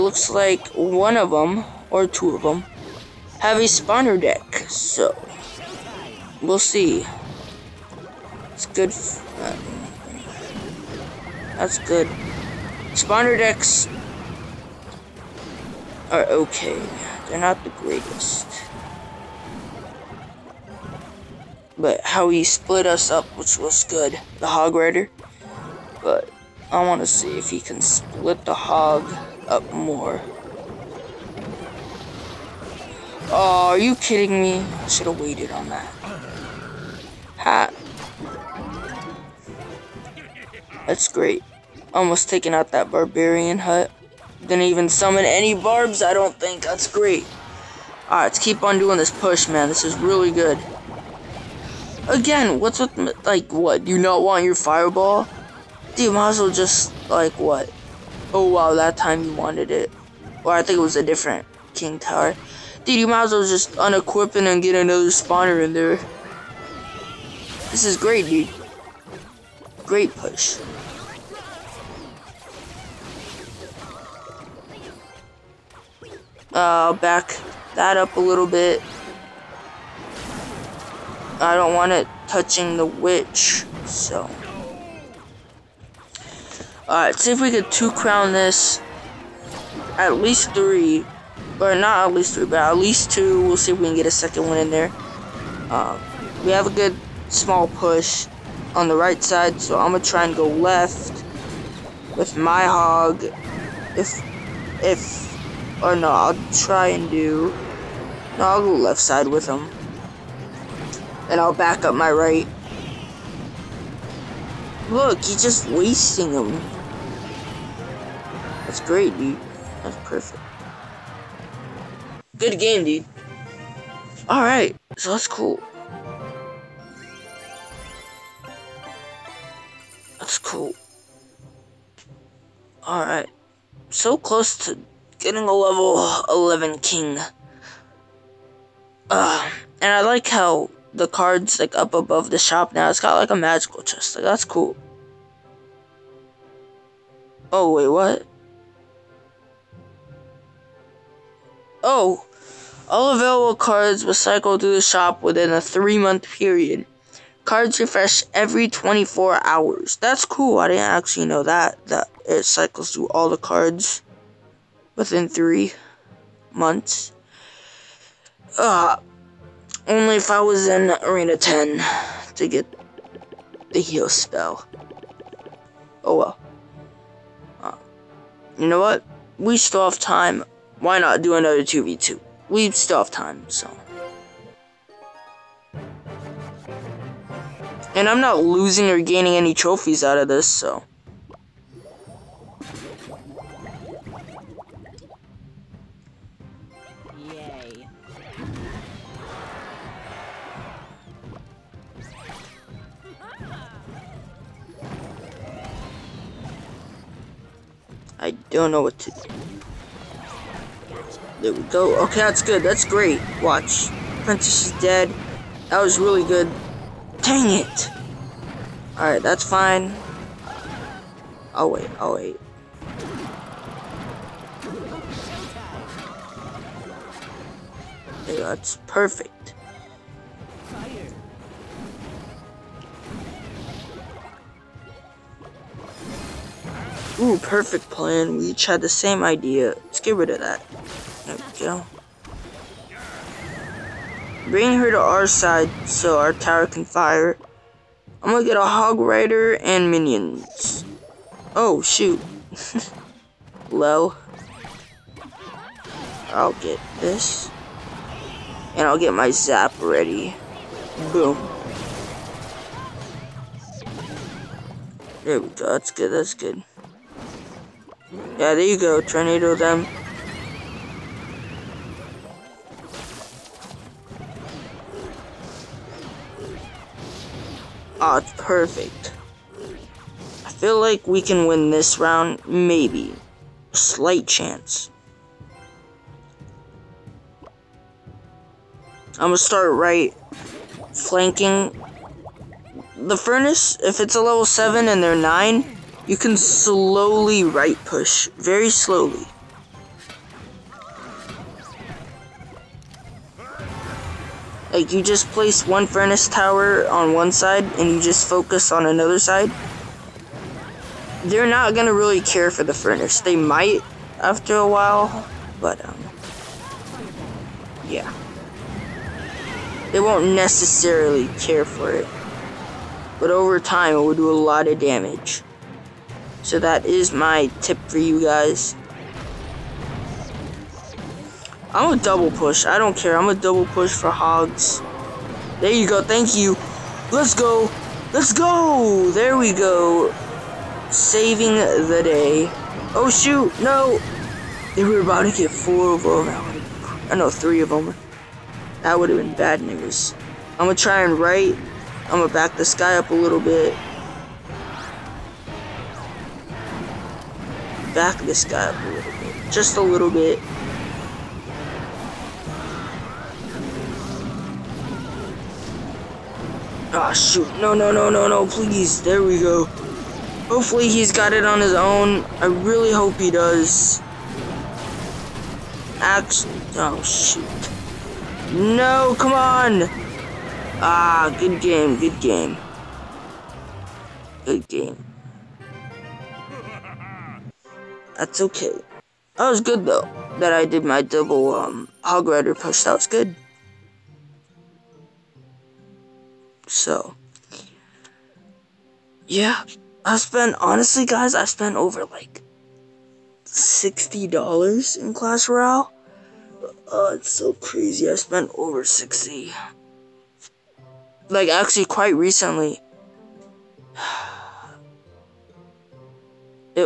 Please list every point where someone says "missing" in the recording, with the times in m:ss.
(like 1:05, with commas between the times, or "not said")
not said.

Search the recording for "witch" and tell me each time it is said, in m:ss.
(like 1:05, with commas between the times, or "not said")
1:22.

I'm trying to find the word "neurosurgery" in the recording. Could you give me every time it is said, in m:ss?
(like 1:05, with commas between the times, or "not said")
not said.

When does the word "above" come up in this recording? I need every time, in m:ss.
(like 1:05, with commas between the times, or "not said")
2:21.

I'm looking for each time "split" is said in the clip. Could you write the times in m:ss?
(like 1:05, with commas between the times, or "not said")
0:22, 0:27.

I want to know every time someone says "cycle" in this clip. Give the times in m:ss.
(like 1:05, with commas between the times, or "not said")
2:34, 2:42.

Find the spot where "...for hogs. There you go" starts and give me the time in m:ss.
5:33.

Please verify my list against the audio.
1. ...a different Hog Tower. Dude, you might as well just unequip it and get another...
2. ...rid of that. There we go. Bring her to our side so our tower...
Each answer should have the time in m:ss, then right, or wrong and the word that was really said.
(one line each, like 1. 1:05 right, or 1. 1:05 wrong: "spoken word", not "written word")
1. 1:00 wrong: "King", not "Hog"
2. 4:00 right.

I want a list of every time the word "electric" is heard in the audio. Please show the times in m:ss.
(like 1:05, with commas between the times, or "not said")
not said.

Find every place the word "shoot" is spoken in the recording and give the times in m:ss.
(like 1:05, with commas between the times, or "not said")
4:11, 5:43, 6:07, 6:17.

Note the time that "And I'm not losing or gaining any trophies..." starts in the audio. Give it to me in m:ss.
3:07.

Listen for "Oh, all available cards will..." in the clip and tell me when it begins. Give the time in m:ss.
2:31.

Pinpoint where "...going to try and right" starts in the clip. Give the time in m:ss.
5:50.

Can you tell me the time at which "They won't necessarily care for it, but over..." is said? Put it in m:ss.
5:19.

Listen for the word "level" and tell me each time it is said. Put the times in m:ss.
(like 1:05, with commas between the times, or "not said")
2:15, 4:54.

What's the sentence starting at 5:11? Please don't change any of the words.
They're not gonna really care for the furnace.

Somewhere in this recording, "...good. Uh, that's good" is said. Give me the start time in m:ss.
0:08.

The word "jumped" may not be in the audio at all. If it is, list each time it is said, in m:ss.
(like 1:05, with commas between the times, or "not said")
not said.